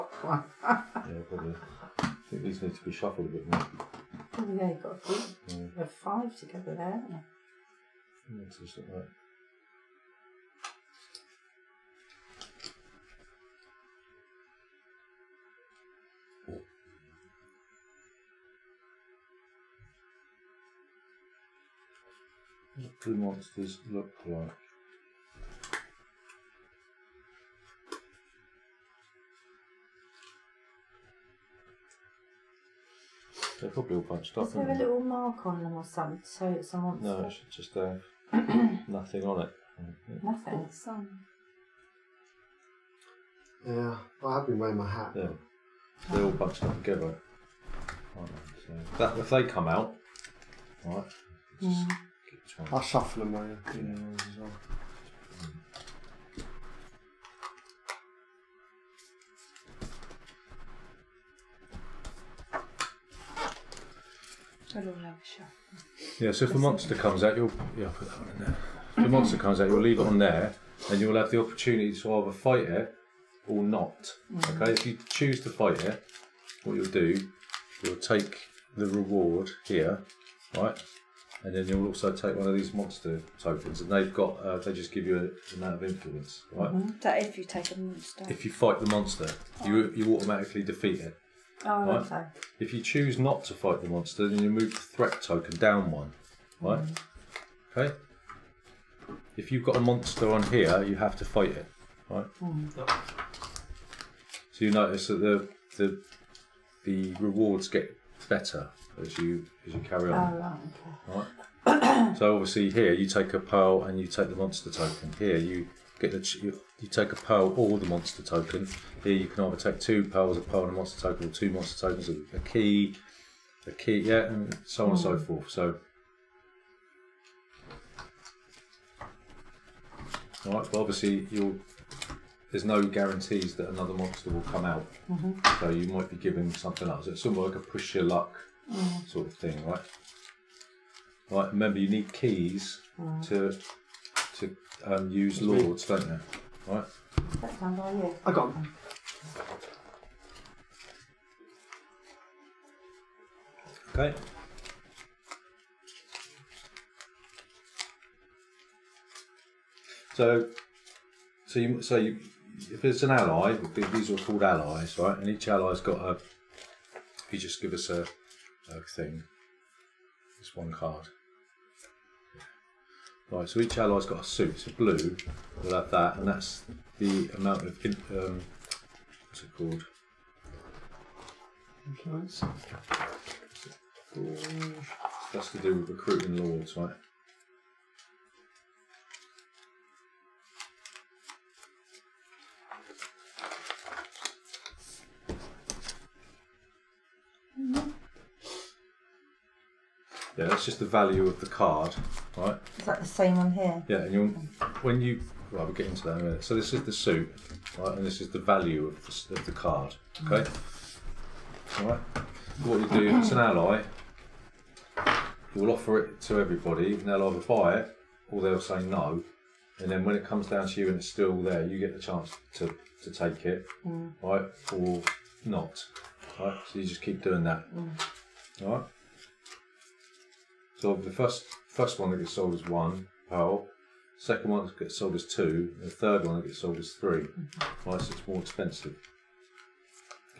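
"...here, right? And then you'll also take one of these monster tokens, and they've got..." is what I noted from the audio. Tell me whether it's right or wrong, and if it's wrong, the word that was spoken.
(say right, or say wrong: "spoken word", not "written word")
right.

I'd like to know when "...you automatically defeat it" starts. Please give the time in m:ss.
1:29.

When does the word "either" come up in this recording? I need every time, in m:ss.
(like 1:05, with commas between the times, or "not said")
1:12, 1:59, 3:37.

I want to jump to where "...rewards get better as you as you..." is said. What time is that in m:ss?
1:47.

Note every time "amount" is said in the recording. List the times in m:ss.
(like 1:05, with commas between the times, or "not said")
1:25, 2:57.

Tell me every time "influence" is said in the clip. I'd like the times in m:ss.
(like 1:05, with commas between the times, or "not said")
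1:25, 3:01.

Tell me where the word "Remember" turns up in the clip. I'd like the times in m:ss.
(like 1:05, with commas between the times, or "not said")
2:21.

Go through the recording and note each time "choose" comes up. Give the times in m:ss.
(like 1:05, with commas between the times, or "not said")
1:15, 1:32.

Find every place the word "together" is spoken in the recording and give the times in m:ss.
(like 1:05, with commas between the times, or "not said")
0:06, 0:46.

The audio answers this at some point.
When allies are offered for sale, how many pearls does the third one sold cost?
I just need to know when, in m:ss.
3:56.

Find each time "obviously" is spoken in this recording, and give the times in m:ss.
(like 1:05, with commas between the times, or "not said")
1:52, 2:10.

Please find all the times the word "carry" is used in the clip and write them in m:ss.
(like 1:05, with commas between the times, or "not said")
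1:49.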